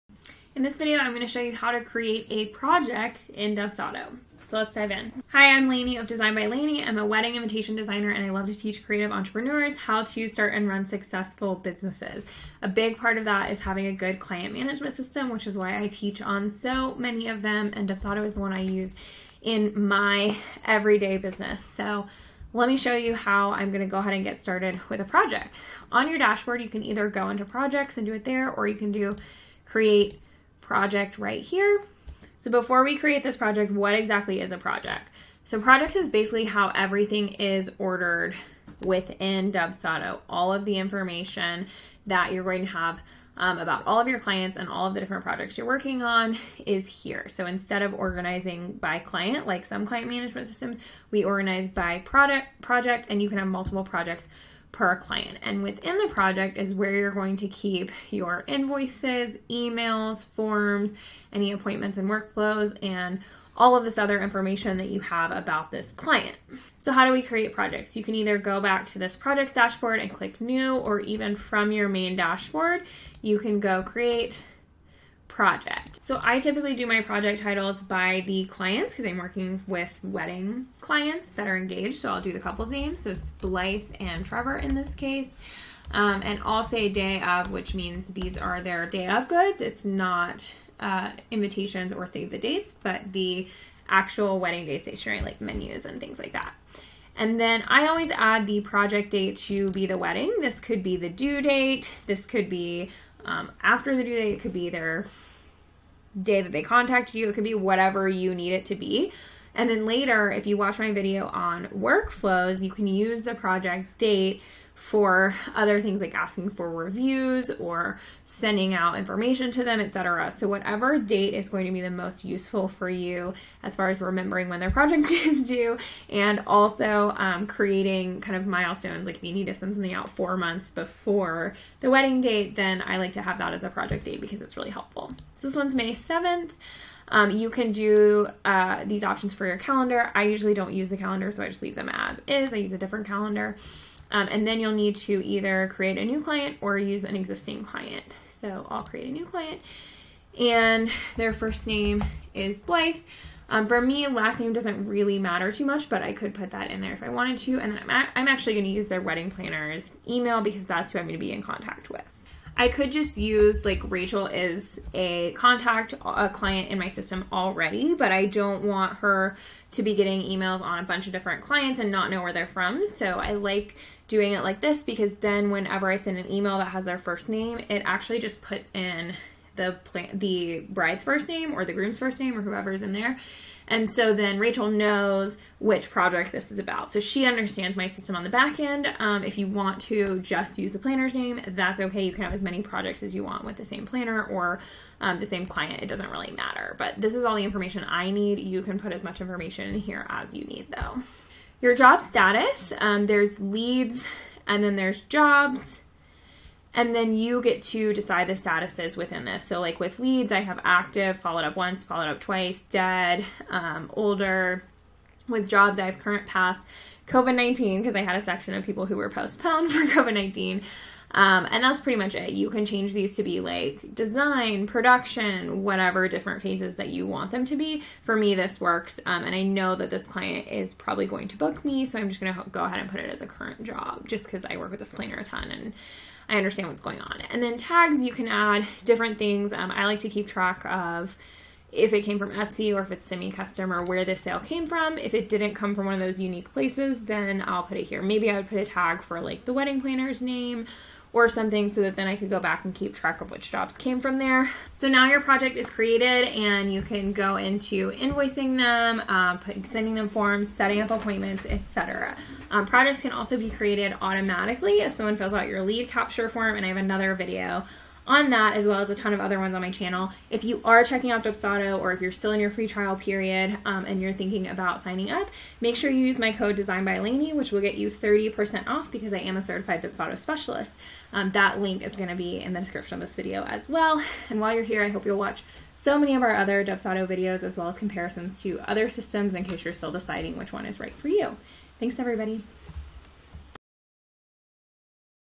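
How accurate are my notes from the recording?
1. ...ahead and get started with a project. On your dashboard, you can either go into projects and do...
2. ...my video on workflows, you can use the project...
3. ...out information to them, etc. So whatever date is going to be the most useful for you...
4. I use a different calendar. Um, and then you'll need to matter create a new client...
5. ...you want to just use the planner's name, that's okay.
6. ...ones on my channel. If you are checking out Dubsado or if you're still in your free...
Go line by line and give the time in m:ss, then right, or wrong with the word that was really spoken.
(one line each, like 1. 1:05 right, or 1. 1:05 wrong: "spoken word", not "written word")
1. 0:23 right
2. 1:50 right
3. 1:58 right
4. 2:22 wrong: "either", not "matter"
5. 3:09 right
6. 4:29 right.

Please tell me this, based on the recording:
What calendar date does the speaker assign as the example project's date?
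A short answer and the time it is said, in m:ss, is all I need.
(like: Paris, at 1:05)
May 7th, at 2:15.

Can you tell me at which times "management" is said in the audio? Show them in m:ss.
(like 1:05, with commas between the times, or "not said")
0:14, 0:50.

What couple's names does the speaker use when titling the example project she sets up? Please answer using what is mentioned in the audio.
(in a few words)
Blythe and Trevor.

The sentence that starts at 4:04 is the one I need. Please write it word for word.
If it didn't come from one of those unique places, then I'll put it here.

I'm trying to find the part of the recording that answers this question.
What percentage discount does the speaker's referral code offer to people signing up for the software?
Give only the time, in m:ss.
4:37.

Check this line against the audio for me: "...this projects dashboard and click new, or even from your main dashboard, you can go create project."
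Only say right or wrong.
right.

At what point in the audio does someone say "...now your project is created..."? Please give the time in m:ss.
4:14.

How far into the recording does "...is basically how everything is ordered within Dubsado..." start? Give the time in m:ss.
0:35.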